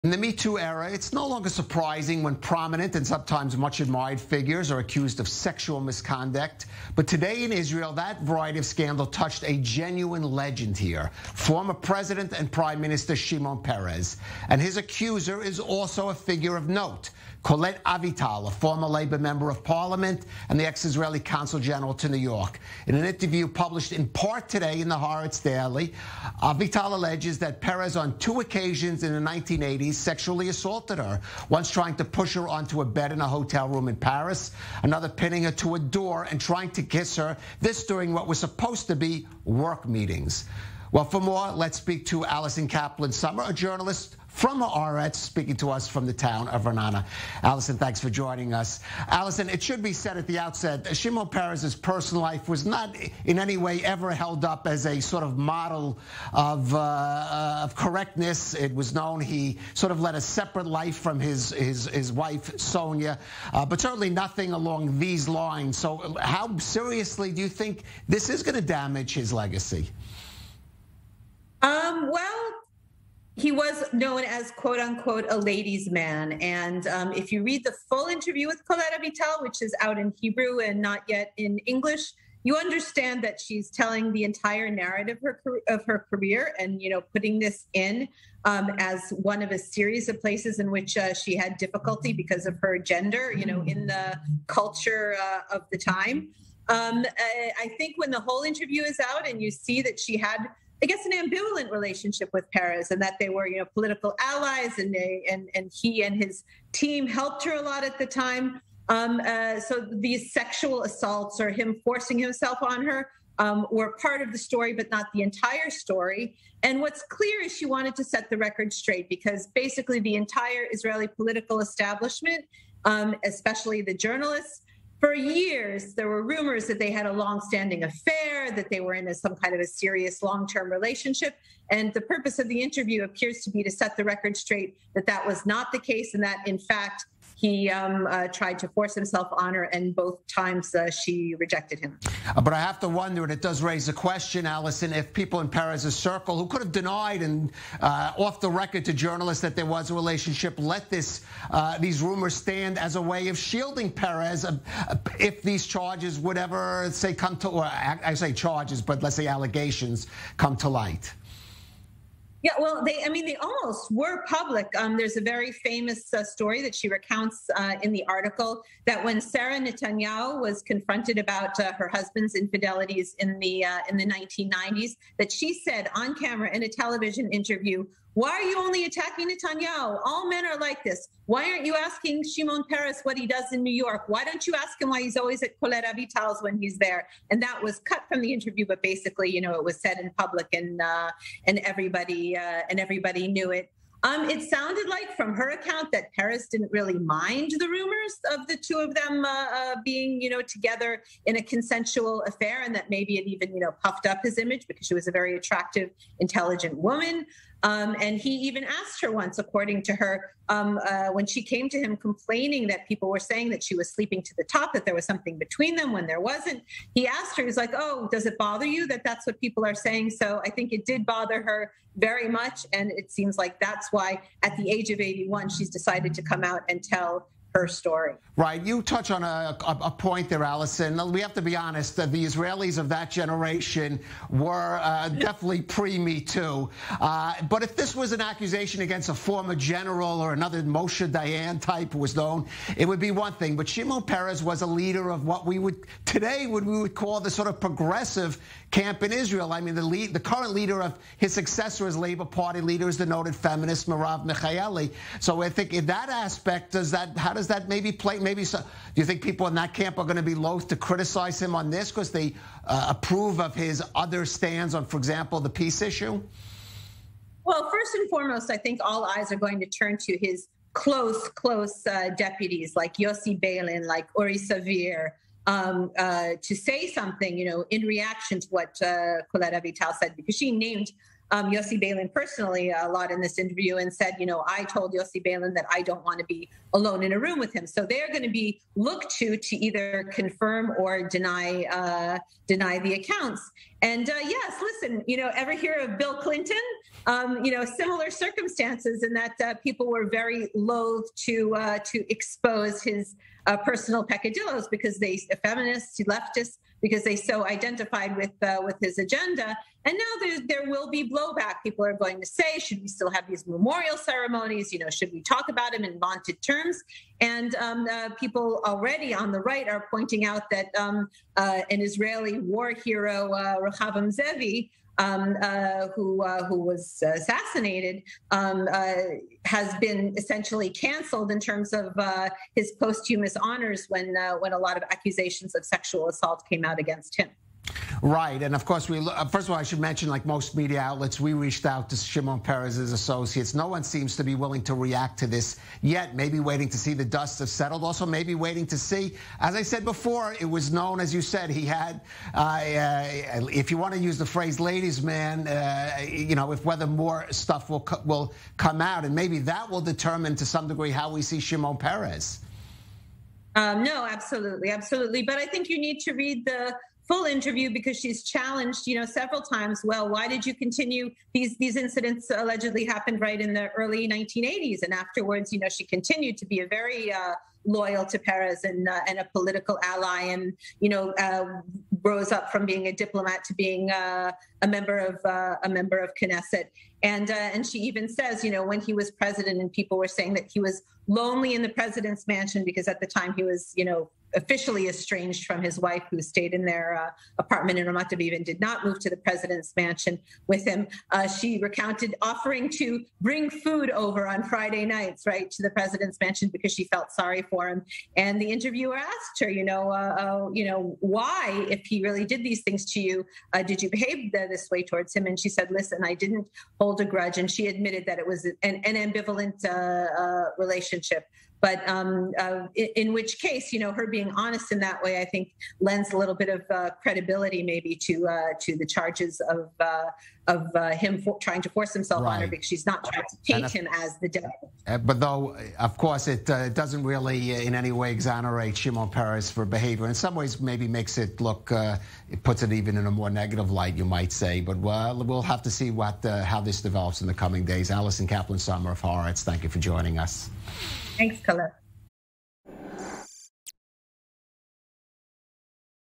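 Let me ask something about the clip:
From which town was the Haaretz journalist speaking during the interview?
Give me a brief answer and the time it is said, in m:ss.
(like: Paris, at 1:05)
Ra'anana, at 0:46.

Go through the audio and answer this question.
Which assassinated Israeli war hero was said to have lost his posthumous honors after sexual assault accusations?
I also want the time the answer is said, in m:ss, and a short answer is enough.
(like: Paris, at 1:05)
Rechavam Ze'evi, at 5:23.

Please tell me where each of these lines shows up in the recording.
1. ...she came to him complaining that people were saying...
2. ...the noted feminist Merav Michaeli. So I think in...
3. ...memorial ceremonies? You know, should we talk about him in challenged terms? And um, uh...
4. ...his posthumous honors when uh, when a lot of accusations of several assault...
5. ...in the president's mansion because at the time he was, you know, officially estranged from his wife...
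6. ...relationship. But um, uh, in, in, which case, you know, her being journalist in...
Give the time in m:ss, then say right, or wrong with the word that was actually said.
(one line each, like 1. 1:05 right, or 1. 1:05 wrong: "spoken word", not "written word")
1. 3:31 right
2. 4:12 right
3. 5:13 wrong: "vaunted", not "challenged"
4. 5:32 wrong: "sexual", not "several"
5. 6:31 right
6. 7:00 wrong: "honest", not "journalist".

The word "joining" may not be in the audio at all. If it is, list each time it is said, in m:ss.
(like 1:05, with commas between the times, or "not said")
0:48, 7:29.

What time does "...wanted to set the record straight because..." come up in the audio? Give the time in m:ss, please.
1:57.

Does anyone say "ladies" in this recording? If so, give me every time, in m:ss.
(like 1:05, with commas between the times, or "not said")
1:15, 5:54.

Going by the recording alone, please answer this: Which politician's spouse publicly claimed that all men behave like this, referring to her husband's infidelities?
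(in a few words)
Sarah Netanyahu.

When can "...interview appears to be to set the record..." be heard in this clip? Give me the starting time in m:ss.
2:12.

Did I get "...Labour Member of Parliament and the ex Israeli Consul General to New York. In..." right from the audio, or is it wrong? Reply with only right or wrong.
right.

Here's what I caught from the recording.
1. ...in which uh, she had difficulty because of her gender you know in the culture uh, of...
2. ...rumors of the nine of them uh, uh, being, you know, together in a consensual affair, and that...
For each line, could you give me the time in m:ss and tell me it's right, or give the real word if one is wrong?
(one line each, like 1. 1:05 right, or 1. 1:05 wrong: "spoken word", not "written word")
1. 1:30 right
2. 3:17 wrong: "two", not "nine".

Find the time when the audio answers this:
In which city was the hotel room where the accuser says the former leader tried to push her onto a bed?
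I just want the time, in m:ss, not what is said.
0:33.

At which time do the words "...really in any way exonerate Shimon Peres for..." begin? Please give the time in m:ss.
7:17.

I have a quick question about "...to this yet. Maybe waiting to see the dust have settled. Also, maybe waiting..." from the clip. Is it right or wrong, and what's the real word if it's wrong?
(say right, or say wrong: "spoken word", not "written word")
right.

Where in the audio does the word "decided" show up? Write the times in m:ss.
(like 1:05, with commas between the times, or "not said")
3:45.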